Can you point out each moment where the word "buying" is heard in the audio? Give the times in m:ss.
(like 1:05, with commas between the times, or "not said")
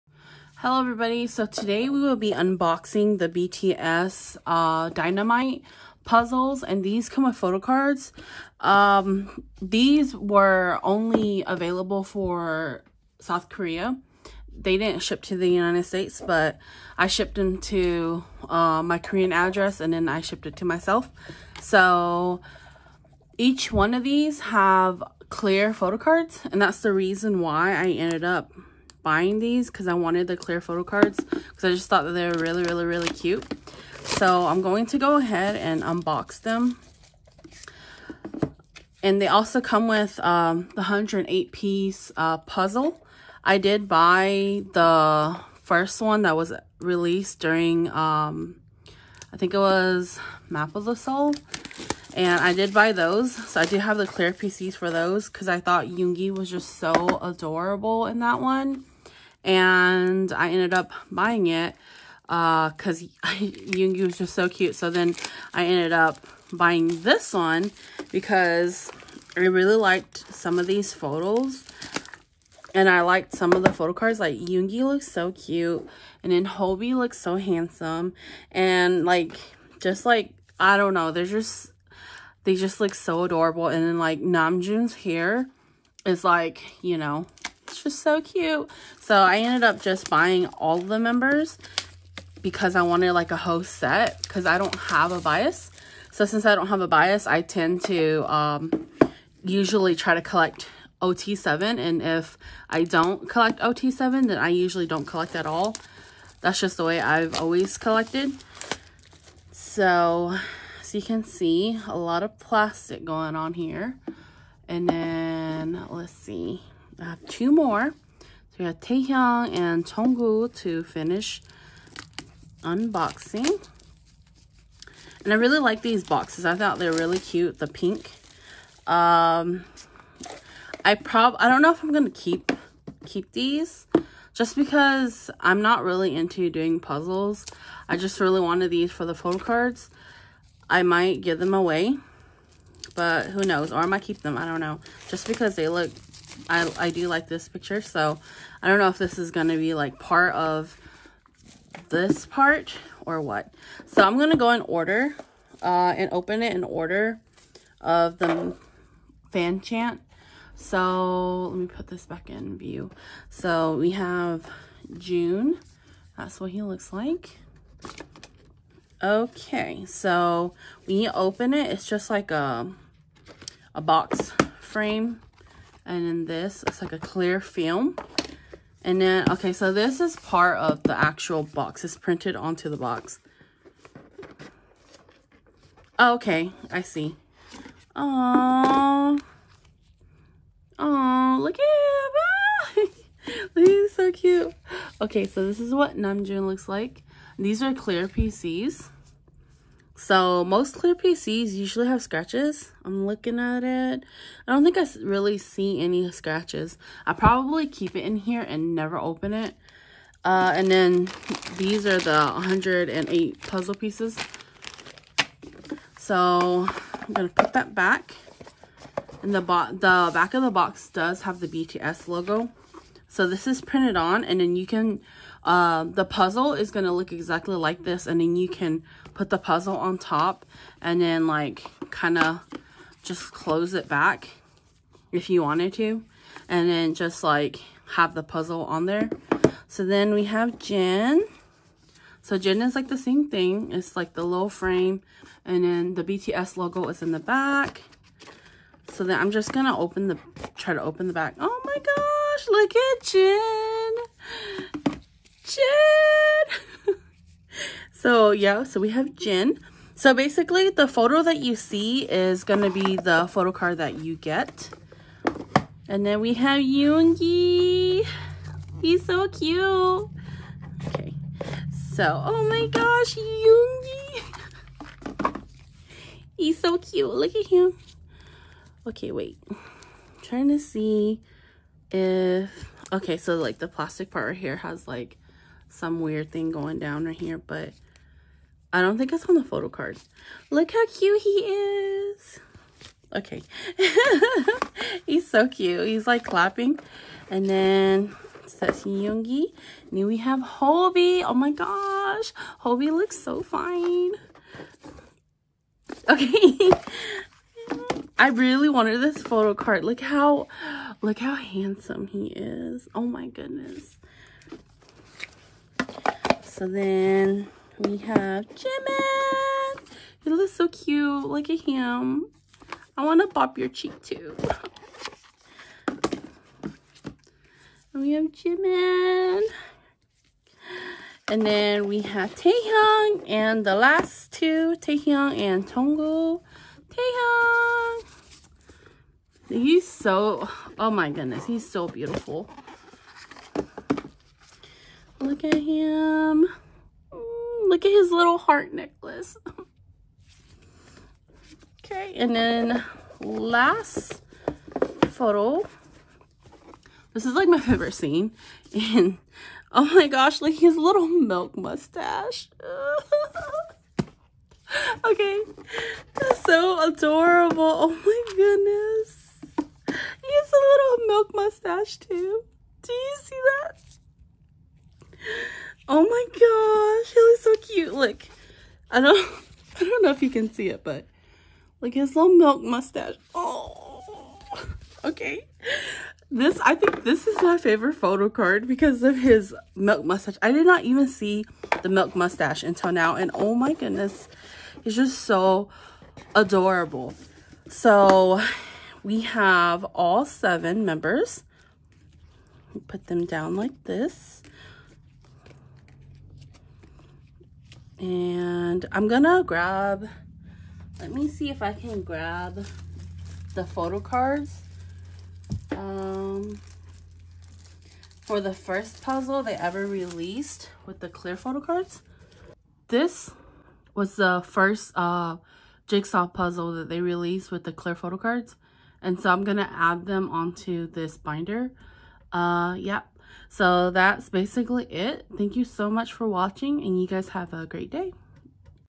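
0:29, 1:01, 1:06, 1:30.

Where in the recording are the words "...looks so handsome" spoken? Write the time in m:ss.
1:16.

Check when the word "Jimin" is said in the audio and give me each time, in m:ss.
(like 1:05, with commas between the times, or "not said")
5:18, 5:28.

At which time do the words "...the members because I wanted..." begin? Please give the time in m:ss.
1:30.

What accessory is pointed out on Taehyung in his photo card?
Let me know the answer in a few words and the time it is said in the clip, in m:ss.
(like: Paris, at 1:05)
Heart necklace, at 5:48.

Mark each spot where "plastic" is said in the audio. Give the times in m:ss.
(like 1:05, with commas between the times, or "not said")
1:52, 4:43.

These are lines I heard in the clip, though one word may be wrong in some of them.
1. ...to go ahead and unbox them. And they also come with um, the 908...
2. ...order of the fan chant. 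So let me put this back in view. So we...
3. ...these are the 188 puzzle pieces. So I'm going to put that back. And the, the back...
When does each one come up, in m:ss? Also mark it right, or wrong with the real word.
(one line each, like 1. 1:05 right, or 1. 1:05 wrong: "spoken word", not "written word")
1. 0:34 wrong: "108", not "908"
2. 2:36 right
3. 3:31 wrong: "108", not "188".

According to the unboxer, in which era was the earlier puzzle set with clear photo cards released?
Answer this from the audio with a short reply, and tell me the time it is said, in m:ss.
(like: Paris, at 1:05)
Map of the Soul, at 0:50.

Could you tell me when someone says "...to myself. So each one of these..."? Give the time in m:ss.
0:20.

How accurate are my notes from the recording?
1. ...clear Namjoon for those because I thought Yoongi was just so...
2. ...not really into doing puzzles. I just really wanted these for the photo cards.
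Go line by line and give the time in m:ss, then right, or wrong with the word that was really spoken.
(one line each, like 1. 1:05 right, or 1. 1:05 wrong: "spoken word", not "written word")
1. 0:54 wrong: "PCs", not "Namjoon"
2. 2:15 right.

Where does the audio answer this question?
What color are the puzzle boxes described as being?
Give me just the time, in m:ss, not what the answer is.
2:07.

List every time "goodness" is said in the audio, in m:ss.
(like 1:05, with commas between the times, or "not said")
5:13, 5:41, 6:08, 6:33.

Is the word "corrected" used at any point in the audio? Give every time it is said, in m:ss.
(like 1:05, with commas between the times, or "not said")
not said.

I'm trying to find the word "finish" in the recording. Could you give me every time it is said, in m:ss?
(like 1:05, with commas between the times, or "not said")
2:00.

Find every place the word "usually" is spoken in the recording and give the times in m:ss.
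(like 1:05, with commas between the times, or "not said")
1:39, 1:44, 3:21.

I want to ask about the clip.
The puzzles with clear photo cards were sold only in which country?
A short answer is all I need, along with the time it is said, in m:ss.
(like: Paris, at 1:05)
South Korea, at 0:13.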